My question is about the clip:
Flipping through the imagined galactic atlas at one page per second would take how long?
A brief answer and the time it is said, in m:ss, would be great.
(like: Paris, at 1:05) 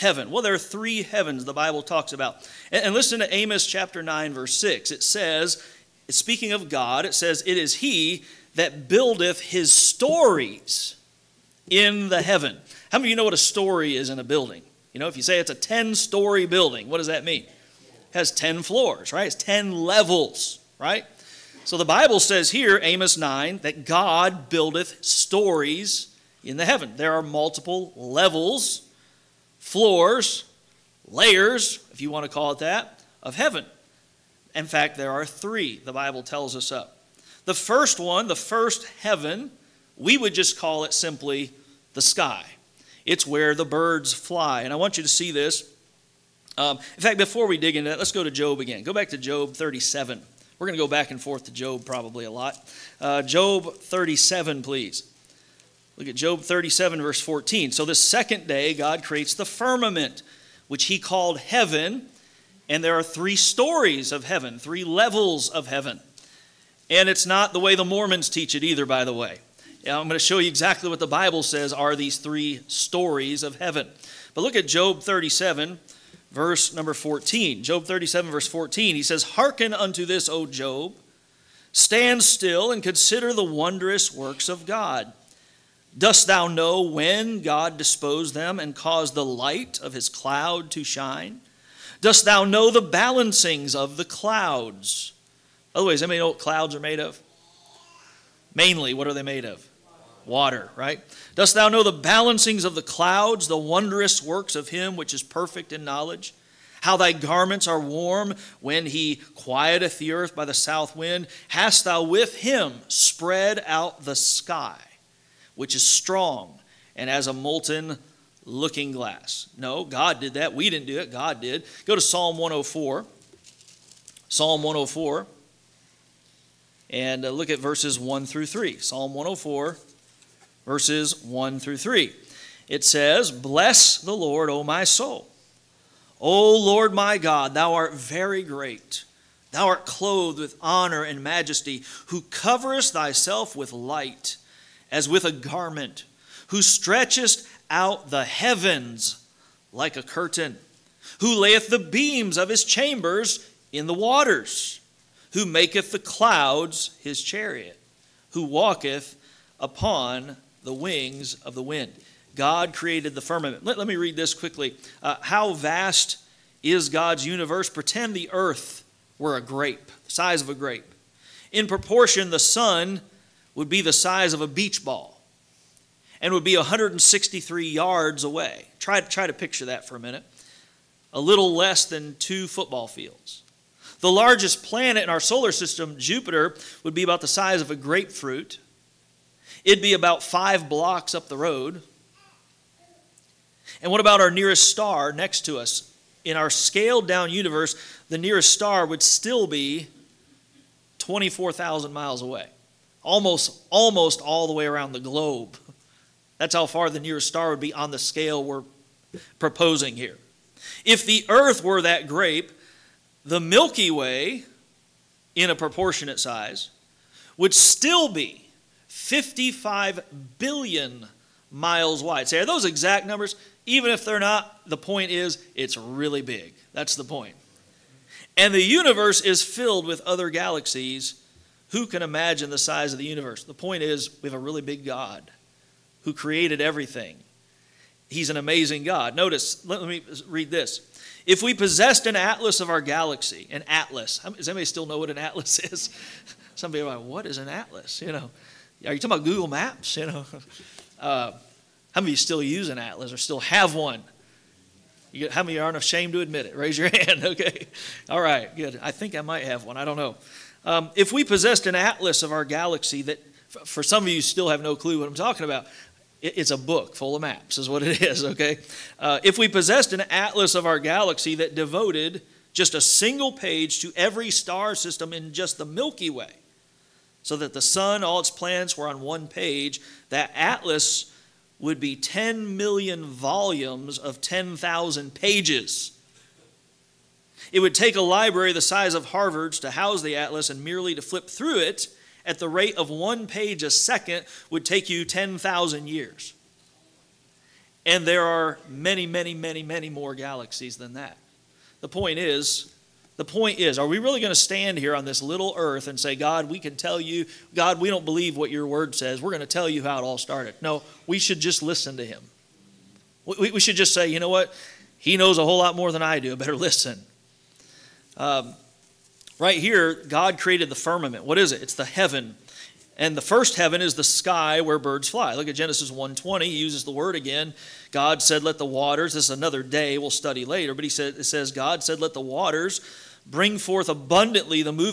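10,000 years, at 4:55.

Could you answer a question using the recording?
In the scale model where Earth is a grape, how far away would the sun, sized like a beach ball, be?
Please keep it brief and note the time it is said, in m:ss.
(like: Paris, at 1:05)
163 yards, at 2:56.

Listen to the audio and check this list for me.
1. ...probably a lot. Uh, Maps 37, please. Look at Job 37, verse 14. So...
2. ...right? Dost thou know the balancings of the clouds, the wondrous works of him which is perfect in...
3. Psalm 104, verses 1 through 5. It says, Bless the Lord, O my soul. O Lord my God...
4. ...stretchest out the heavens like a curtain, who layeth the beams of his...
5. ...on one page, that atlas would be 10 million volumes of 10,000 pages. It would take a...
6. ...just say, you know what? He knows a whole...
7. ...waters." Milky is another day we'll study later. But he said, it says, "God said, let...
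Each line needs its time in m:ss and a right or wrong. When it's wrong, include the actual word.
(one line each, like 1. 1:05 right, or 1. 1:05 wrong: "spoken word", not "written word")
1. 0:51 wrong: "Job", not "Maps"
2. 1:40 right
3. 2:08 wrong: "3", not "5"
4. 2:26 right
5. 4:38 right
6. 5:13 right
7. 5:28 wrong: "This", not "Milky".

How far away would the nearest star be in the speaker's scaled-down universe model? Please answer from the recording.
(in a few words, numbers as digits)
24,000 miles.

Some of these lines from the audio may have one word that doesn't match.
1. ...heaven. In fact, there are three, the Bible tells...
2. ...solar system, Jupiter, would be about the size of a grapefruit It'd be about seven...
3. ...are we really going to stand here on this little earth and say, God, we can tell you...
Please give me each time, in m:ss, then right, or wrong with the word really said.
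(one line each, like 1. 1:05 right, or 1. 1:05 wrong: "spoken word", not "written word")
1. 0:33 right
2. 3:05 wrong: "five", not "seven"
3. 5:03 right.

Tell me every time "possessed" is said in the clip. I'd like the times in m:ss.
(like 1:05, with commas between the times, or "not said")
4:01, 4:21, 4:29.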